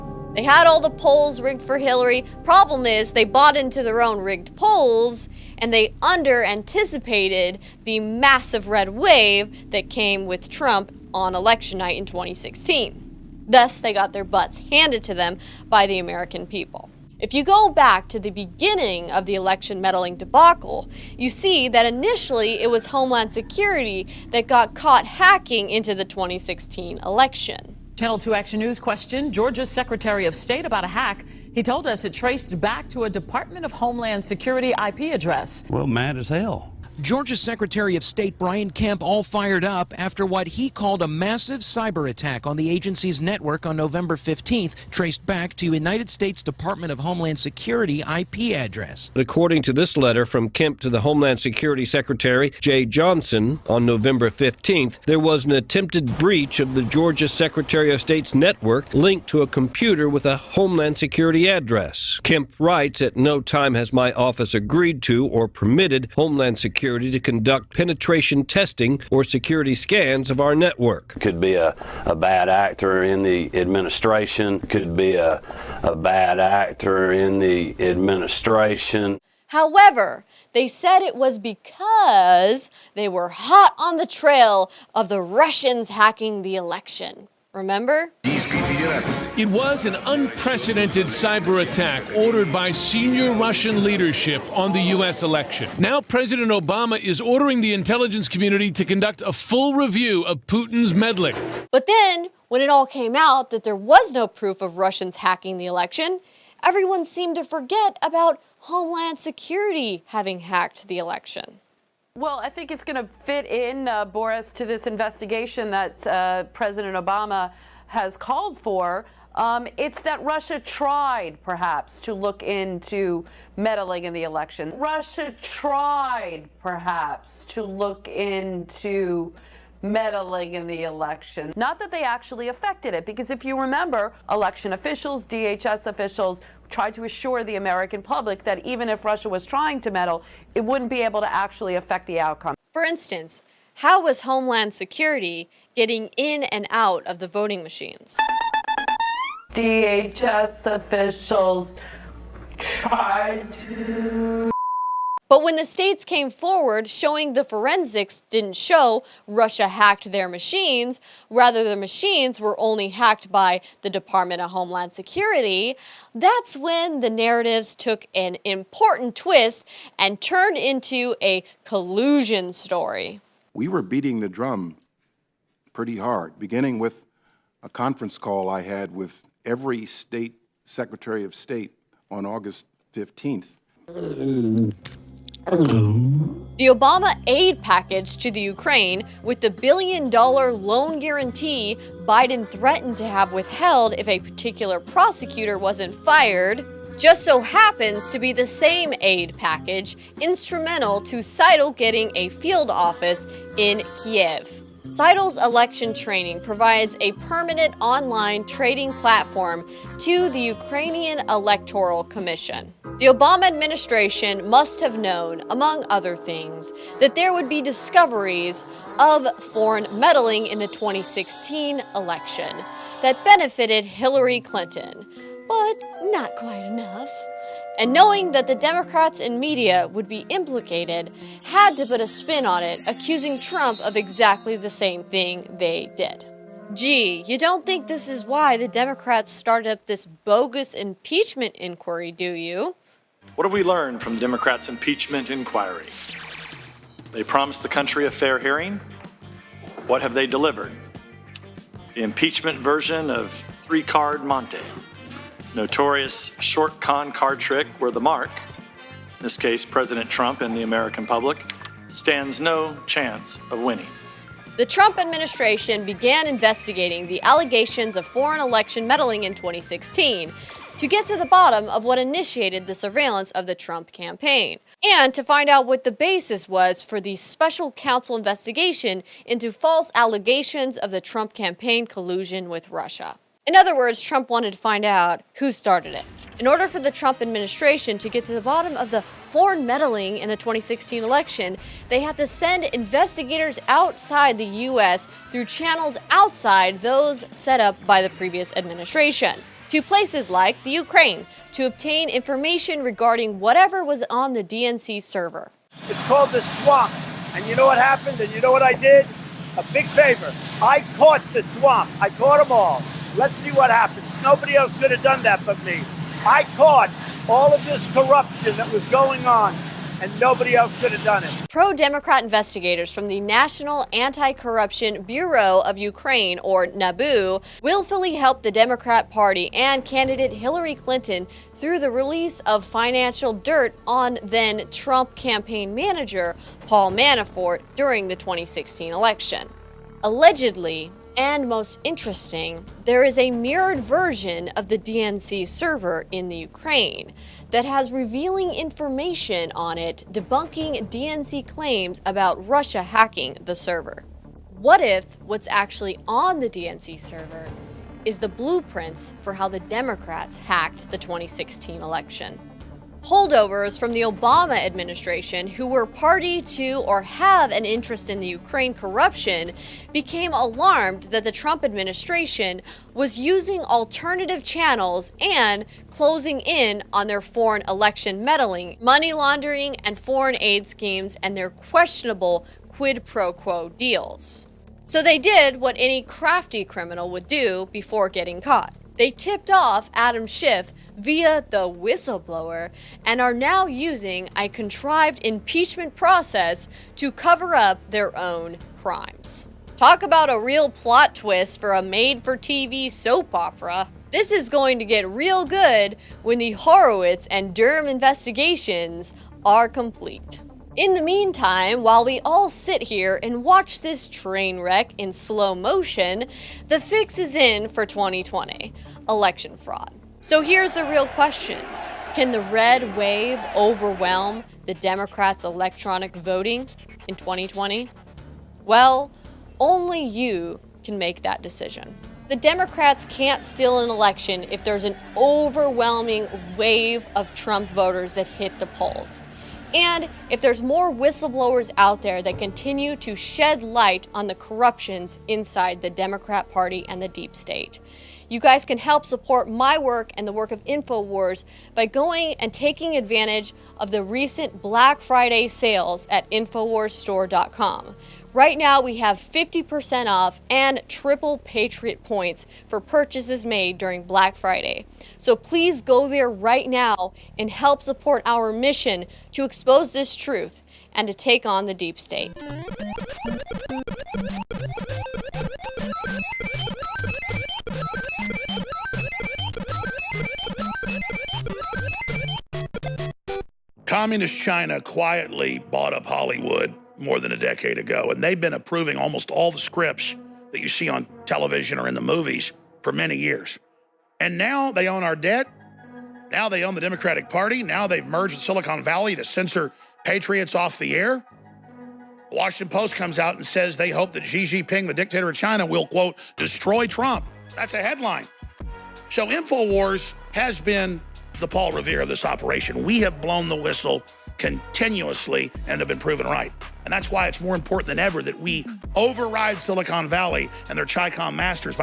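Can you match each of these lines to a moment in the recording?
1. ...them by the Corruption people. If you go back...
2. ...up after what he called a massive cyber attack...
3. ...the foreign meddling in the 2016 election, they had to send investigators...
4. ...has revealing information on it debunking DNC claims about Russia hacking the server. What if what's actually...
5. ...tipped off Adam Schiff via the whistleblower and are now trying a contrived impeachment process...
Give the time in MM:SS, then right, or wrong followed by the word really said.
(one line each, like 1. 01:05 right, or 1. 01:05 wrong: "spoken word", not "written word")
1. 00:15 wrong: "American", not "Corruption"
2. 00:39 right
3. 04:48 right
4. 05:47 right
5. 06:29 wrong: "using", not "trying".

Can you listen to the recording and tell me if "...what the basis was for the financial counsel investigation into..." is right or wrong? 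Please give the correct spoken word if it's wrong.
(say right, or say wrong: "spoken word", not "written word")
wrong: "special", not "financial".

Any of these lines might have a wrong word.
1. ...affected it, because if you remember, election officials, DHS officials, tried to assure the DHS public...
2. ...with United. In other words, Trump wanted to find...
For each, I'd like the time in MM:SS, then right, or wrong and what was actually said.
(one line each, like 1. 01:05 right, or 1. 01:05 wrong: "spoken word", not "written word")
1. 02:12 wrong: "American", not "DHS"
2. 04:42 wrong: "Russia", not "United".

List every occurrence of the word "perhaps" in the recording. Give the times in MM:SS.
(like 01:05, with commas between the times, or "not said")
02:01, 02:06.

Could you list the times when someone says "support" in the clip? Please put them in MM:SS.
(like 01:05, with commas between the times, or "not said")
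07:29, 07:47.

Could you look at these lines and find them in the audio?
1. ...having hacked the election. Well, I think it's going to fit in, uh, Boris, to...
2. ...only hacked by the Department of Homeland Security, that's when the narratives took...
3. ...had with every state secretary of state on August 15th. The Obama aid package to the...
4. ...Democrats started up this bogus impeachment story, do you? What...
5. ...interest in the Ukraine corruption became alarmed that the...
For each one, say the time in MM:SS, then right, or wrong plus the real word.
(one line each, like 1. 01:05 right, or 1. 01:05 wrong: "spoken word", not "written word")
1. 01:50 right
2. 02:42 right
3. 02:58 right
4. 03:58 wrong: "inquiry", not "story"
5. 06:07 right.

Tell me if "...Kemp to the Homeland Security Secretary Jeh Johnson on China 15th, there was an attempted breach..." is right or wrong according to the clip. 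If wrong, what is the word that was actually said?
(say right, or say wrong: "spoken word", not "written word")
wrong: "November", not "China".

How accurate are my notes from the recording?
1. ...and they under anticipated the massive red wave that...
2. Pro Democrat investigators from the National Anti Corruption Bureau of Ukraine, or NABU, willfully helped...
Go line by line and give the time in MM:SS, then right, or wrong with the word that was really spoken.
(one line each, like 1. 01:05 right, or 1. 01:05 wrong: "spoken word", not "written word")
1. 00:05 right
2. 05:21 right.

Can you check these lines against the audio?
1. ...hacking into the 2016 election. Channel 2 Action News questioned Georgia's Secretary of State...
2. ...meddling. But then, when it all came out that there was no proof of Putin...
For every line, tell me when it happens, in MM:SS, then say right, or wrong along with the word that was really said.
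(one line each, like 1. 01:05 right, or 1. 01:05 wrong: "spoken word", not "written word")
1. 00:25 right
2. 01:40 wrong: "Russians", not "Putin".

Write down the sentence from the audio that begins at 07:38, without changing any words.
Right now, we have 50% off and triple Patriot points for purchases made during Black Friday.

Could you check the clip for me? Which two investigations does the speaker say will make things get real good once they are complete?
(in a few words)
Horowitz and Durham.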